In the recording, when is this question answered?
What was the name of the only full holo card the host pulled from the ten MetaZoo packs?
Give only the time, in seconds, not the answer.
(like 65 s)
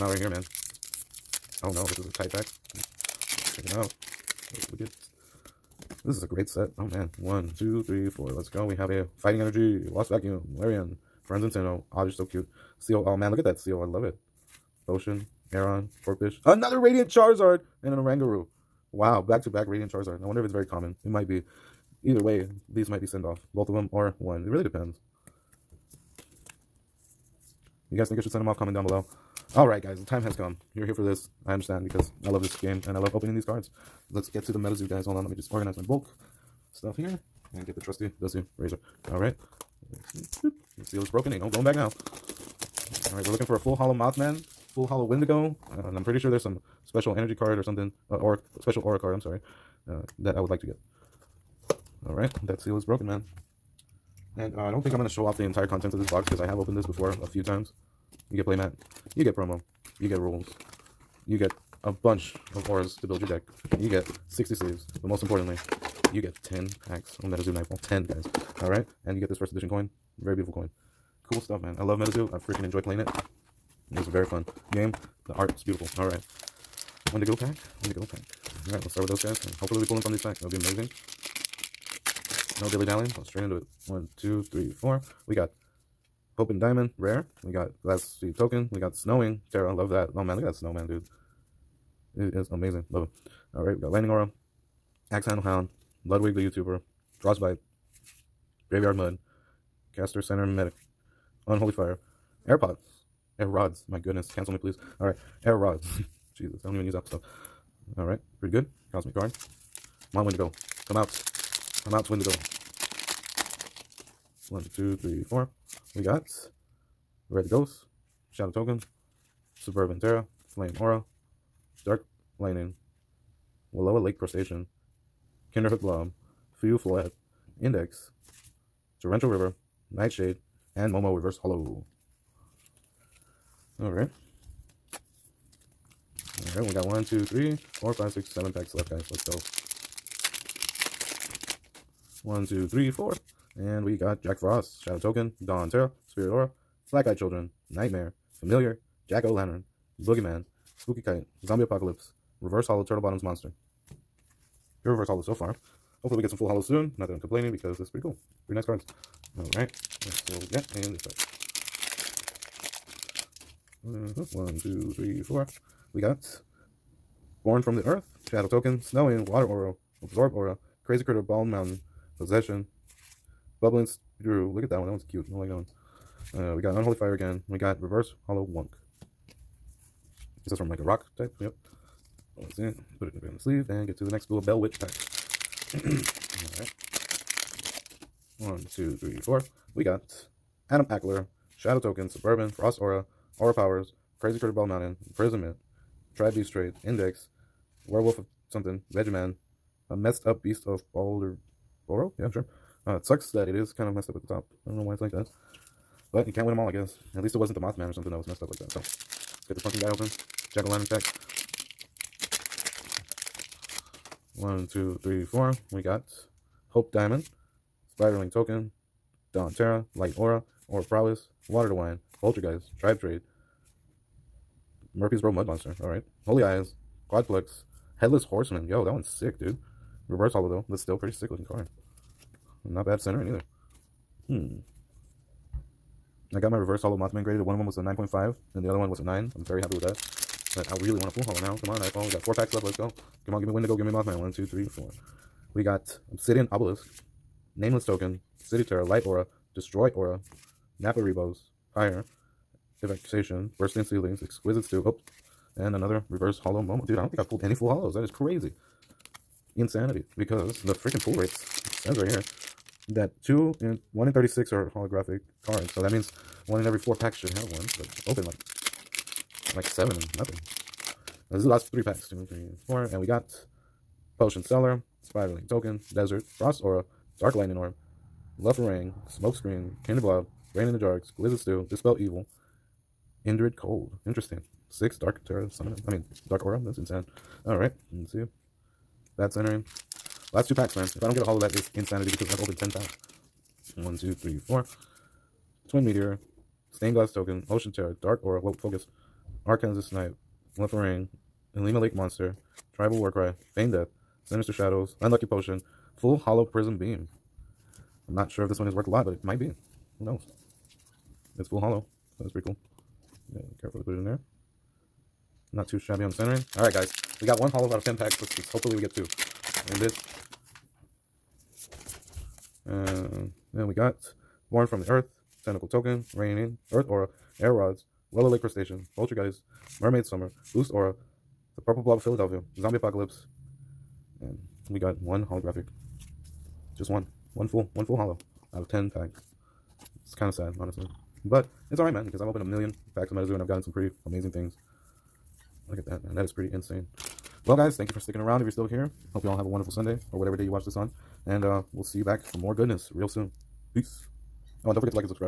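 306 s.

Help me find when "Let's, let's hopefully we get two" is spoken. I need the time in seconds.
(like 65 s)
318 s.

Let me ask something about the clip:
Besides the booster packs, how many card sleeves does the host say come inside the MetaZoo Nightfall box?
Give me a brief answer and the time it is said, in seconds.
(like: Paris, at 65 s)
60, at 64 s.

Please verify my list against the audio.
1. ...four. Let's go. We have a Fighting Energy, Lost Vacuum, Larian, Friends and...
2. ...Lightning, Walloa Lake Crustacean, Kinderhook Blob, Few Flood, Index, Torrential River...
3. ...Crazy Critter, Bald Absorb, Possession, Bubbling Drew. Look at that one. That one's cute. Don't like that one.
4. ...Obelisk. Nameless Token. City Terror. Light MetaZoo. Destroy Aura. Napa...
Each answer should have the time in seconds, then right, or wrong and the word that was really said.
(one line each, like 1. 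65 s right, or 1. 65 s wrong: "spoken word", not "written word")
1. 8 s right
2. 122 s right
3. 170 s wrong: "Mountain", not "Absorb"
4. 246 s wrong: "Aura", not "MetaZoo".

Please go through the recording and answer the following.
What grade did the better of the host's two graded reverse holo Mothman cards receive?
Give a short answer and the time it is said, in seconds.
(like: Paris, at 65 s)
9.5, at 237 s.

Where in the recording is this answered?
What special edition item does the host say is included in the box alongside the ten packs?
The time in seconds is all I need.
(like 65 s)
69 s.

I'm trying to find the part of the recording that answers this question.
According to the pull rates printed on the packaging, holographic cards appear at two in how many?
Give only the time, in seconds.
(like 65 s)
264 s.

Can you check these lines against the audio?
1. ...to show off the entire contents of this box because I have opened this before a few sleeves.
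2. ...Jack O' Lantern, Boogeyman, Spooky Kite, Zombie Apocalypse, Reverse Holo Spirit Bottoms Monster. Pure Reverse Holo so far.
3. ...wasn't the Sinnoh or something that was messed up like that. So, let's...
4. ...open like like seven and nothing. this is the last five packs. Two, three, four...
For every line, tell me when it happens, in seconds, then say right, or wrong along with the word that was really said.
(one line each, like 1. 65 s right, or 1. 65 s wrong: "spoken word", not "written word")
1. 55 s wrong: "times", not "sleeves"
2. 149 s wrong: "Turtle", not "Spirit"
3. 207 s wrong: "Mothman", not "Sinnoh"
4. 268 s wrong: "three", not "five".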